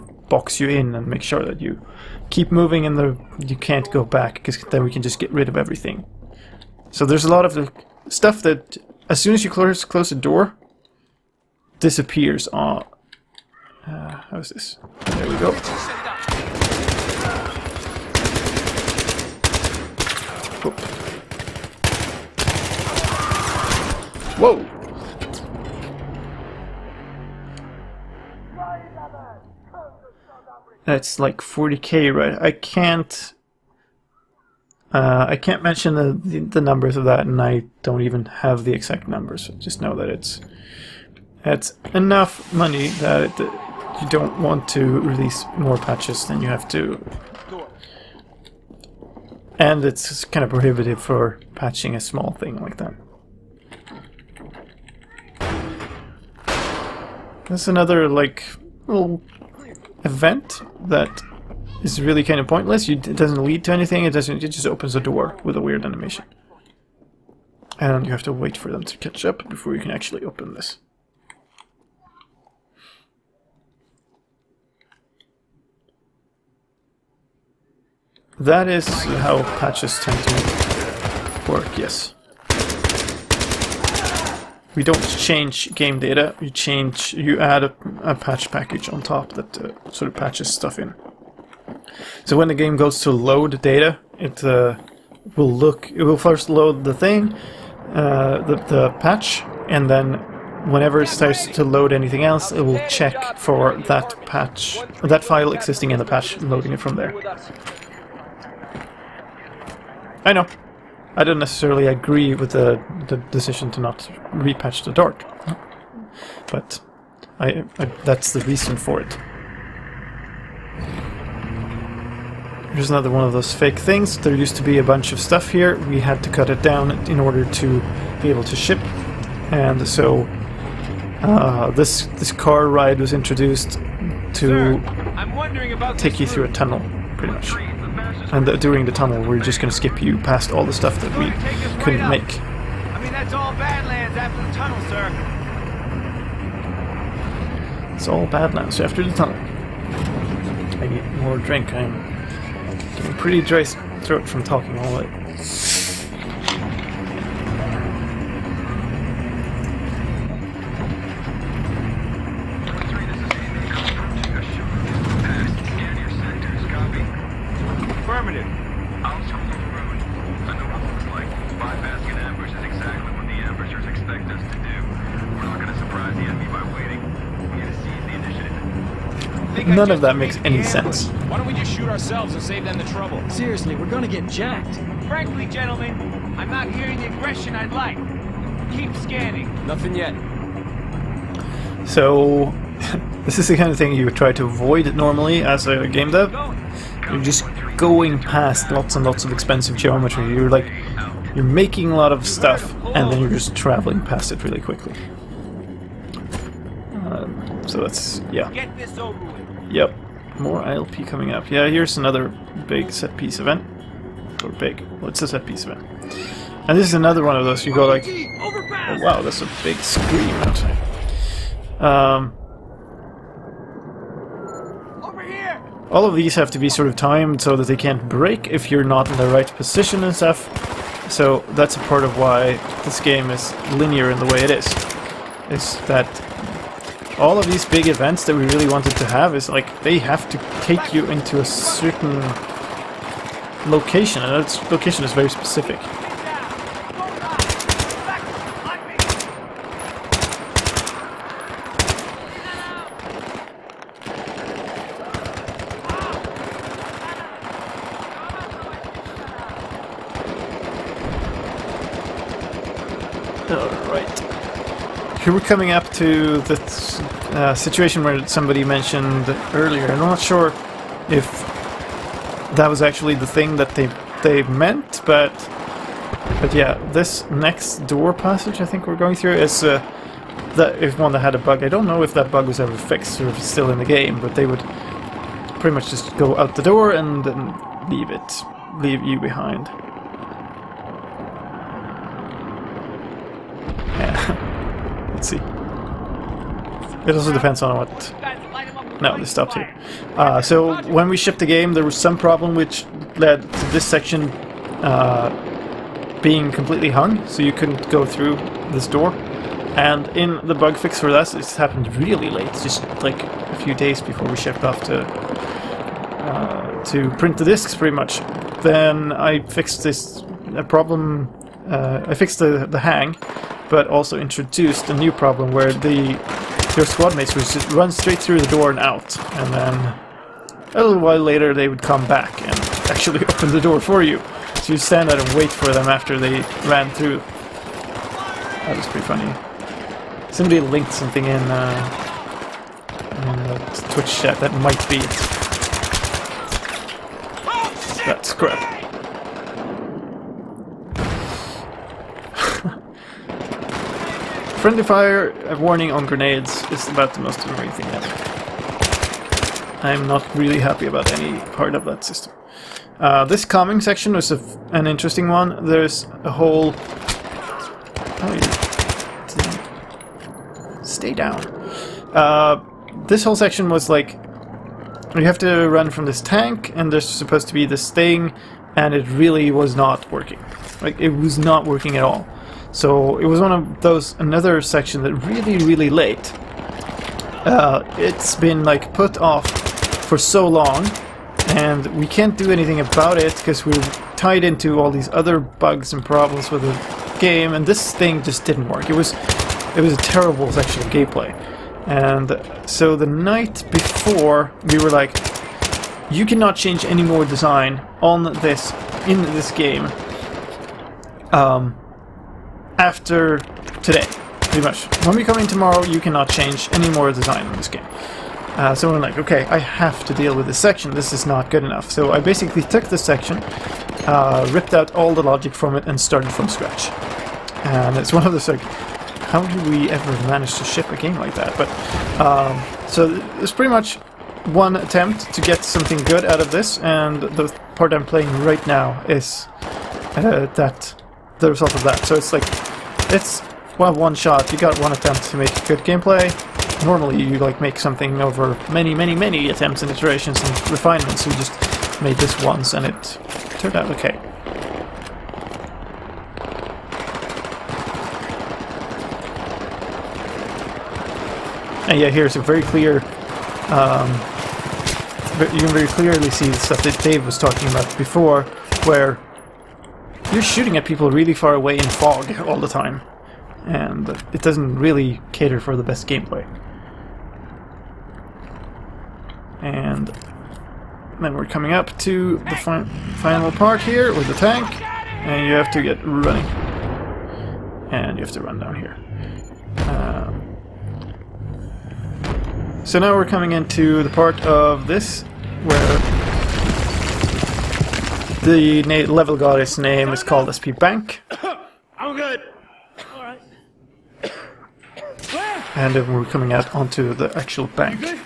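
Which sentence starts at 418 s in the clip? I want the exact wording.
Uh, so I'm like, okay, I have to deal with this section, this is not good enough.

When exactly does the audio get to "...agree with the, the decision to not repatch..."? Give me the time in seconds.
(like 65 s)
111 s.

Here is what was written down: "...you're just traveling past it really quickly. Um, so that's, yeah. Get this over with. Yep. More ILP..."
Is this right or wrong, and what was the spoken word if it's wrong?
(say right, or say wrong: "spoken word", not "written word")
right.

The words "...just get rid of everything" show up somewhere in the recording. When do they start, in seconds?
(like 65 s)
5 s.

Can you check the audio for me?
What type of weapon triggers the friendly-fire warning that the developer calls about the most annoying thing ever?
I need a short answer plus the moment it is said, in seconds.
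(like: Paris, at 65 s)
grenades, at 356 s.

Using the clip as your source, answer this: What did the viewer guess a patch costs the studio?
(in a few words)
40k.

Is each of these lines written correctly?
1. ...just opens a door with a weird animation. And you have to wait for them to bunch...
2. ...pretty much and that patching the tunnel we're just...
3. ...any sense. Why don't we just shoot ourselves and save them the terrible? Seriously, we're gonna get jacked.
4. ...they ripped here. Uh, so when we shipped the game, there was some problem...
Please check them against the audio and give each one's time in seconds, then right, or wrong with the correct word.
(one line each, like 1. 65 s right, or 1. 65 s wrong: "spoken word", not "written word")
1. 64 s wrong: "catch", not "bunch"
2. 137 s wrong: "during", not "patching"
3. 180 s wrong: "trouble", not "terrible"
4. 299 s wrong: "stopped", not "ripped".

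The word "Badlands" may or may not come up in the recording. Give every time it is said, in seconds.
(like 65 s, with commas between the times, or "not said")
143 s, 148 s.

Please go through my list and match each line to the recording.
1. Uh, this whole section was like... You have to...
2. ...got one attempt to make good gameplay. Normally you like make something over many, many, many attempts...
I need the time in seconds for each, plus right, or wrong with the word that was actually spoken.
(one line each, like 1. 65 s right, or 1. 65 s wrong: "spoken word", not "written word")
1. 372 s right
2. 444 s right.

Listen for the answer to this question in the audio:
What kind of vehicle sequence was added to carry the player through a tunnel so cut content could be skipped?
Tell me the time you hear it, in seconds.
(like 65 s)
132 s.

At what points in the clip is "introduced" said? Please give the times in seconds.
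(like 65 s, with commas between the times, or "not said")
133 s, 324 s.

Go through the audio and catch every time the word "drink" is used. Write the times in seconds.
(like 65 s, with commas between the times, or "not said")
151 s.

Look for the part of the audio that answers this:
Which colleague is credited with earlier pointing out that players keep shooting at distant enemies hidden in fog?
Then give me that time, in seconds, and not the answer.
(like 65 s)
467 s.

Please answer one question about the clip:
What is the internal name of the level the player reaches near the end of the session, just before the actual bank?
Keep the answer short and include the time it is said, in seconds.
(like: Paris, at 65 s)
SP Bank, at 500 s.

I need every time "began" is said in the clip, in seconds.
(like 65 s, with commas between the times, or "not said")
not said.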